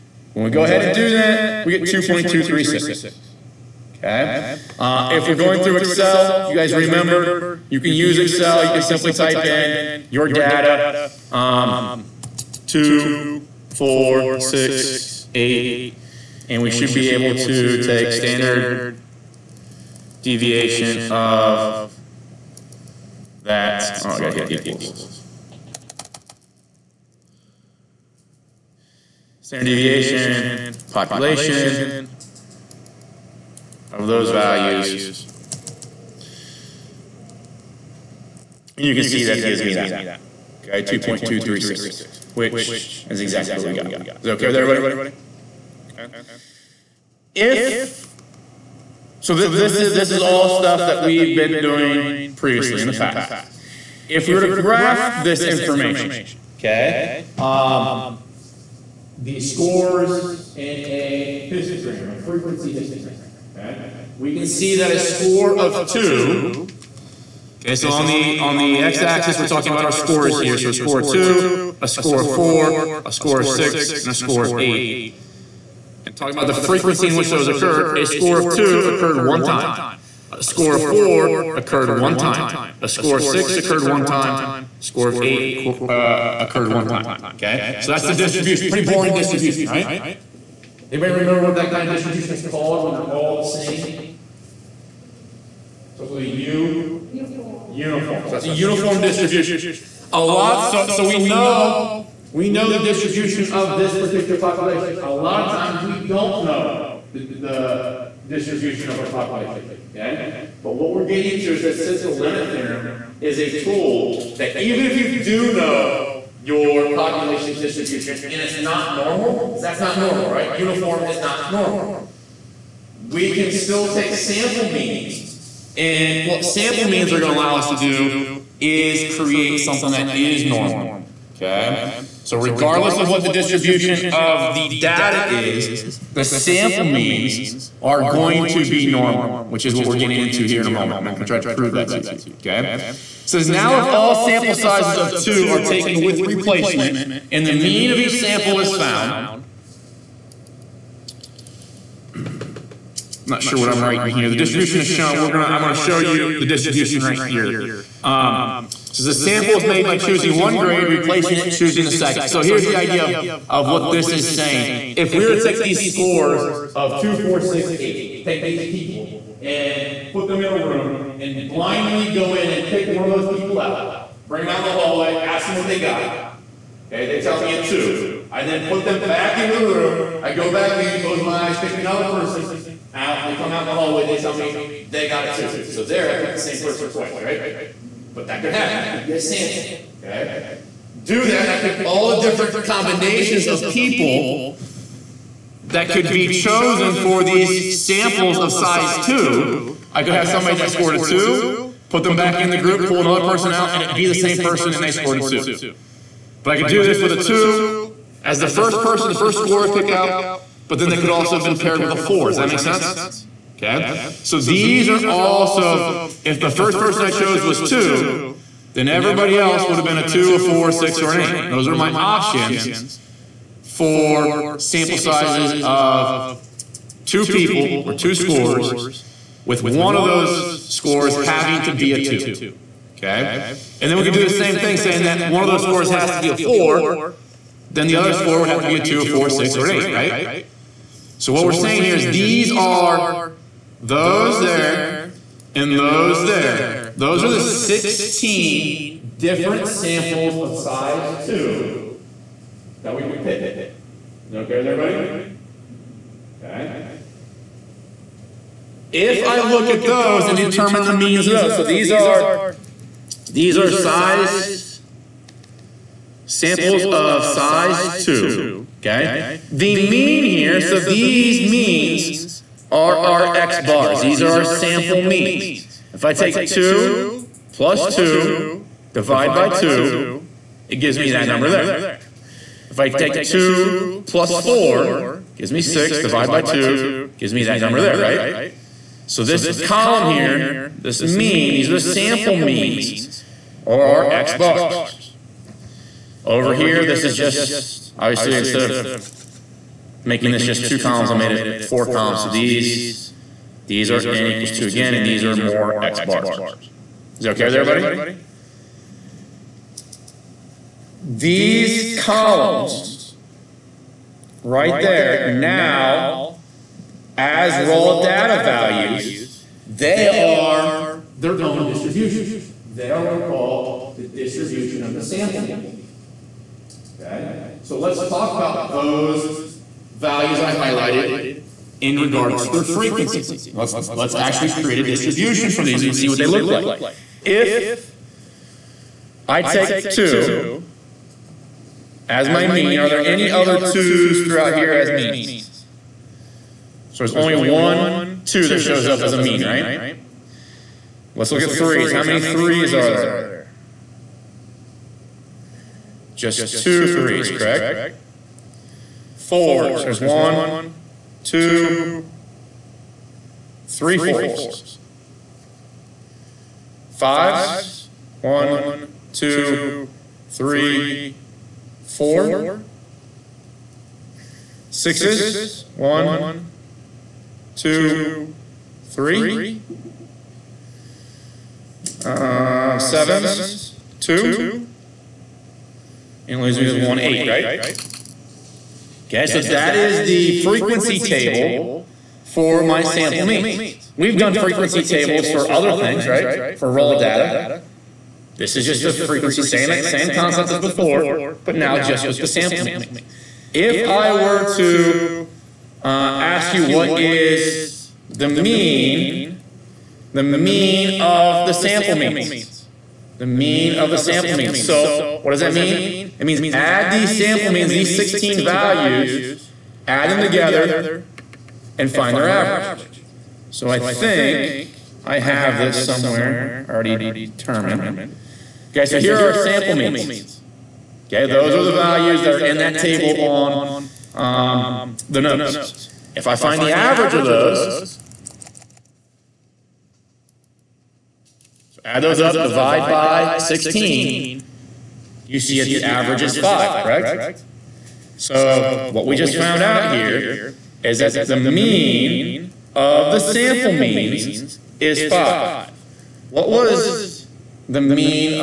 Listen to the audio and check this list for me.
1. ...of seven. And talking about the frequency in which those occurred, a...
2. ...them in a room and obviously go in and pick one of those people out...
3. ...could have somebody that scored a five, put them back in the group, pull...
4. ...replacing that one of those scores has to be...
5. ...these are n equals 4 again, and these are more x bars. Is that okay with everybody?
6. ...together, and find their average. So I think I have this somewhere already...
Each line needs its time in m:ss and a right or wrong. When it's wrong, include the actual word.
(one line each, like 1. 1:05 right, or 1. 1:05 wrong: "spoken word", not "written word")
1. 1:14 wrong: "eight", not "seven"
2. 2:50 wrong: "blindly", not "obviously"
3. 3:20 wrong: "two", not "five"
4. 3:54 wrong: "saying", not "replacing"
5. 5:03 wrong: "2", not "4"
6. 7:00 right.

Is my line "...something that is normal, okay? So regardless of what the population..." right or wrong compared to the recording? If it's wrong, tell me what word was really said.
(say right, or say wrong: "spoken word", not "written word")
wrong: "distribution", not "population".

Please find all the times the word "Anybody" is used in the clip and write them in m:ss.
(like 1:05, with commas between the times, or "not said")
1:30.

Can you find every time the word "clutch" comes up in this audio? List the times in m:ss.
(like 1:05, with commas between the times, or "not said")
not said.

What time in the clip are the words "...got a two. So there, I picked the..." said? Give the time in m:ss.
3:05.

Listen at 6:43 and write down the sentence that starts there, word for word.
If I were to uh, ask you what is the mean, the mean of the sample means.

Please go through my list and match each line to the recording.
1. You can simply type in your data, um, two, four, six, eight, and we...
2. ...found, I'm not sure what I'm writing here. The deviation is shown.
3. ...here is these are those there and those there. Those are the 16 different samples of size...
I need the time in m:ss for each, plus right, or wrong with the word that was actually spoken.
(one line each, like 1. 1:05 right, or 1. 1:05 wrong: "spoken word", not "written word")
1. 0:08 right
2. 2:28 wrong: "distribution", not "deviation"
3. 4:01 right.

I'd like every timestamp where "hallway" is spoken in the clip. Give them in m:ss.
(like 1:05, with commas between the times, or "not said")
2:54, 3:03.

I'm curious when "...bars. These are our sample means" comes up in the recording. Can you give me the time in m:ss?
4:33.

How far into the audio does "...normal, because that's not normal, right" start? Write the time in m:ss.
1:58.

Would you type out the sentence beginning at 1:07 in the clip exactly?
Okay, so on the on the x-axis, we're talking about our scores here.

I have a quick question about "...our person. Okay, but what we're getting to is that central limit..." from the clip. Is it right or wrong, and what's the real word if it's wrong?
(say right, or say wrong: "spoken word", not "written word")
wrong: "population", not "person".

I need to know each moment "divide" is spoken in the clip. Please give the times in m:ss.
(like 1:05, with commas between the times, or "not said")
4:38, 4:45, 7:22.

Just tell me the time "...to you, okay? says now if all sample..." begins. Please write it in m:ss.
2:21.